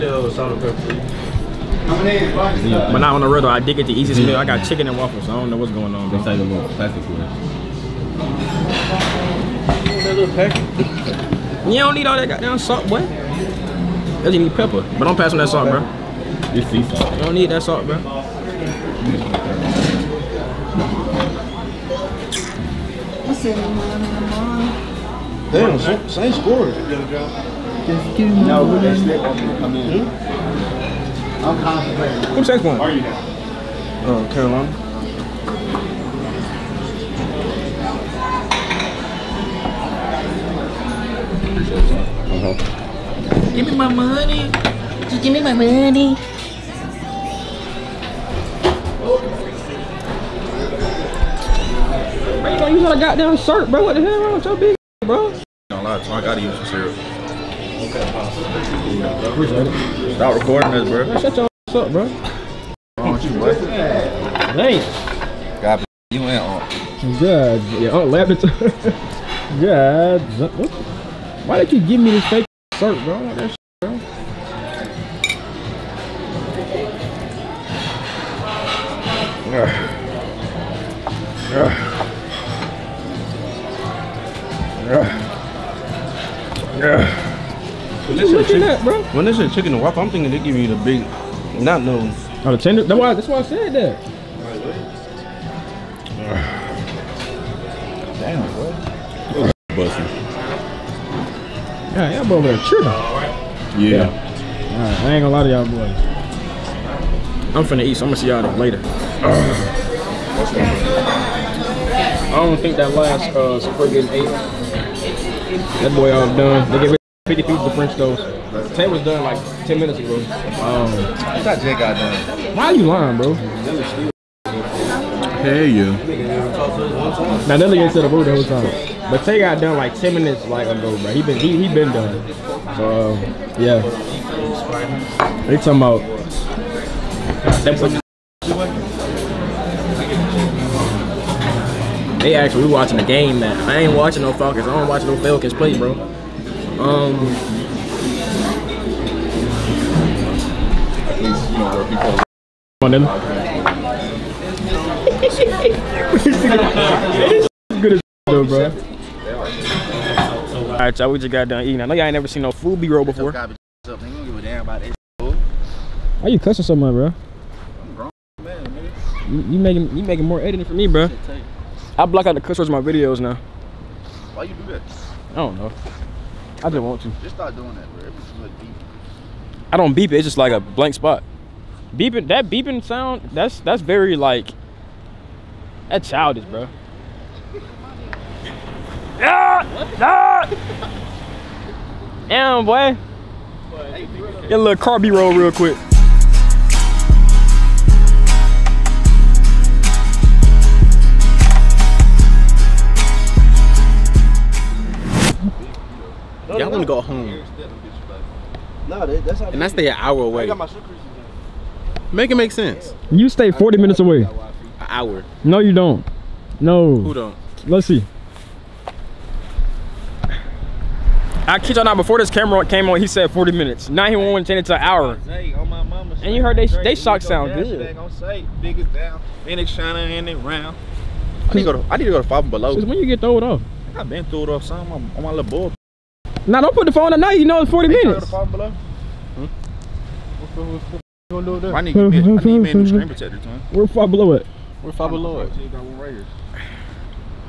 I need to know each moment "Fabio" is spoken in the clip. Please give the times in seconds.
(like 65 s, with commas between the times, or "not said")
244 s.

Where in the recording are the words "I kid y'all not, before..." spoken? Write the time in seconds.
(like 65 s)
221 s.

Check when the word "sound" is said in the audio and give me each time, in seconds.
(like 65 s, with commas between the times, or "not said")
182 s, 227 s.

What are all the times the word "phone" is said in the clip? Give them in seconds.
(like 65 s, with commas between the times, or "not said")
236 s.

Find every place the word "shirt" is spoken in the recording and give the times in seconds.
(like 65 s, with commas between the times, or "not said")
53 s, 72 s.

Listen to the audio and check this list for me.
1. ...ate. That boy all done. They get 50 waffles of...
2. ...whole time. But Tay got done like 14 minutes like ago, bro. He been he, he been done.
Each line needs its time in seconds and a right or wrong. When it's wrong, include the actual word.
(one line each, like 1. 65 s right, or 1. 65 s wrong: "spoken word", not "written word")
1. 113 s wrong: "pieces", not "waffles"
2. 128 s wrong: "10", not "14".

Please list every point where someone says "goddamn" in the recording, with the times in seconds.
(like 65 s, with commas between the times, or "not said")
12 s, 52 s.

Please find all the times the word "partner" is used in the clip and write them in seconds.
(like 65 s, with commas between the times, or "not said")
not said.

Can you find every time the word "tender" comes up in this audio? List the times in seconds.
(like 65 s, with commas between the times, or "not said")
92 s.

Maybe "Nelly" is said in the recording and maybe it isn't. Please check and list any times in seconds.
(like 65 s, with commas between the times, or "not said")
127 s, 153 s.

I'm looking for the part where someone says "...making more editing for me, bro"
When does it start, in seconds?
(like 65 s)
170 s.